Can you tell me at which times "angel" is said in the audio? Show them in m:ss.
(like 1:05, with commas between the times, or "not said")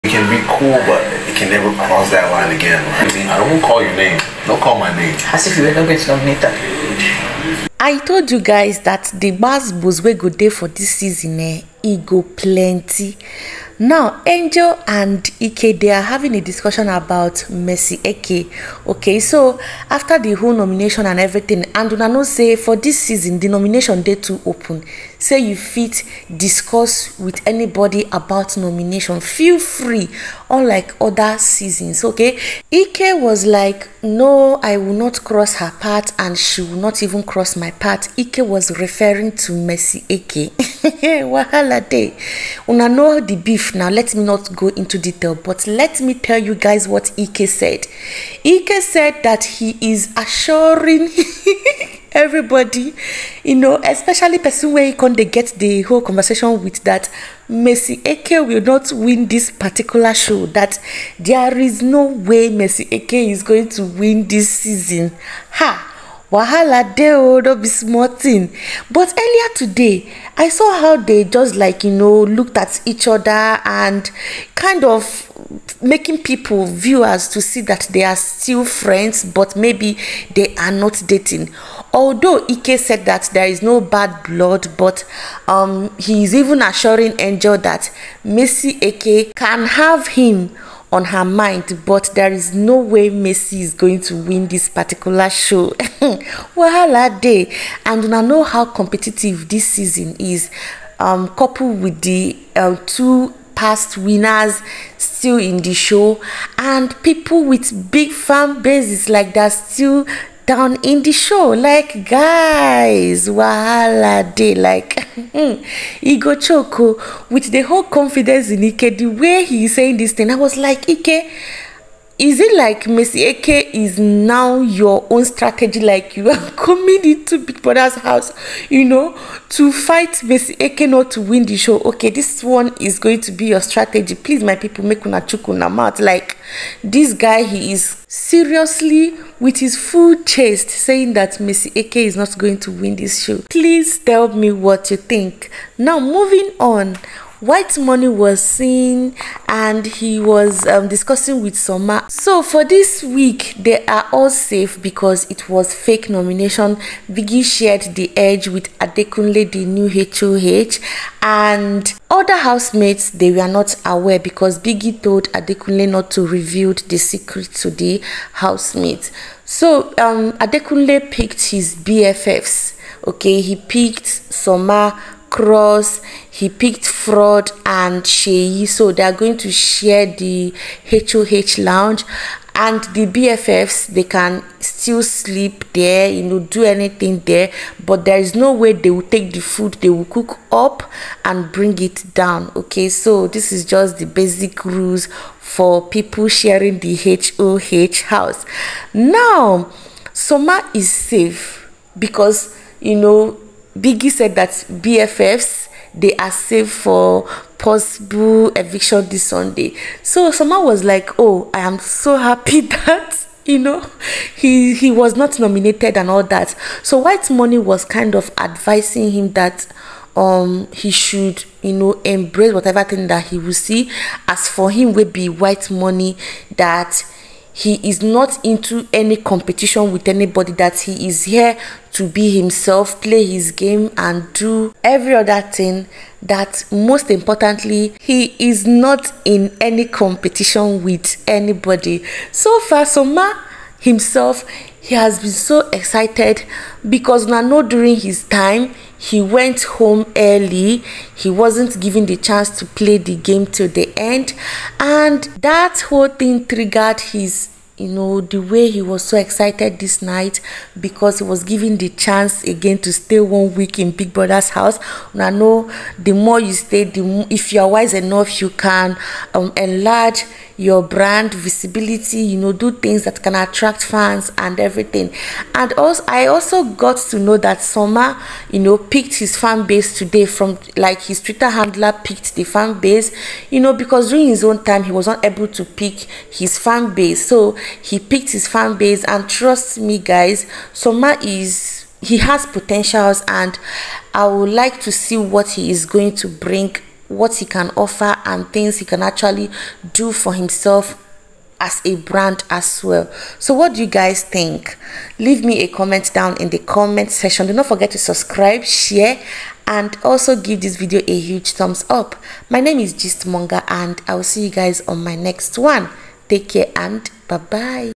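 0:14, 1:27.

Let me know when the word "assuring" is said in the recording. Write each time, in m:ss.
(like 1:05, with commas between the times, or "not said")
0:50, 1:26.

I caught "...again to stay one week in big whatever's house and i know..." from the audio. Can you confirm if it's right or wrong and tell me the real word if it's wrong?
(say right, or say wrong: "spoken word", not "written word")
wrong: "brother", not "whatever".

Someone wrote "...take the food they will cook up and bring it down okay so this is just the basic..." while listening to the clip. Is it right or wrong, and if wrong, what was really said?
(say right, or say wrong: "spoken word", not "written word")
right.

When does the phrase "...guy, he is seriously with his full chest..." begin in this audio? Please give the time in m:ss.
2:17.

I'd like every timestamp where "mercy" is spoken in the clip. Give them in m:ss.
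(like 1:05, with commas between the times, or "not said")
0:17, 0:39, 0:57, 1:02, 1:33, 2:02, 2:10, 2:21.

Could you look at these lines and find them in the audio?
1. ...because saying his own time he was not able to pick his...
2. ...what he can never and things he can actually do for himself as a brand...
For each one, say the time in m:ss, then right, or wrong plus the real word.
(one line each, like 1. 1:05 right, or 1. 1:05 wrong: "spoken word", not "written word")
1. 4:43 wrong: "during", not "saying"
2. 4:57 wrong: "offer", not "never".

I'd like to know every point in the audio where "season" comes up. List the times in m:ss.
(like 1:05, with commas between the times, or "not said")
0:10, 0:22, 0:31, 1:04, 1:39.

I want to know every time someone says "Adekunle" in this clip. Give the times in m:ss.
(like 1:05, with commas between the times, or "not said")
2:38, 2:45, 2:50.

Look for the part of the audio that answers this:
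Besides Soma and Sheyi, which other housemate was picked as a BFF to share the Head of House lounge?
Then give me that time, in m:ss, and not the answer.
2:56.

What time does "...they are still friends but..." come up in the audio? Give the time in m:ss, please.
1:17.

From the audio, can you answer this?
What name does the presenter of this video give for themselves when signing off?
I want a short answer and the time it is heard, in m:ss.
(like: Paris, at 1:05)
Gistmonger, at 5:12.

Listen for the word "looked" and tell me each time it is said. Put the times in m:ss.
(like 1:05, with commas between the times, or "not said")
1:12.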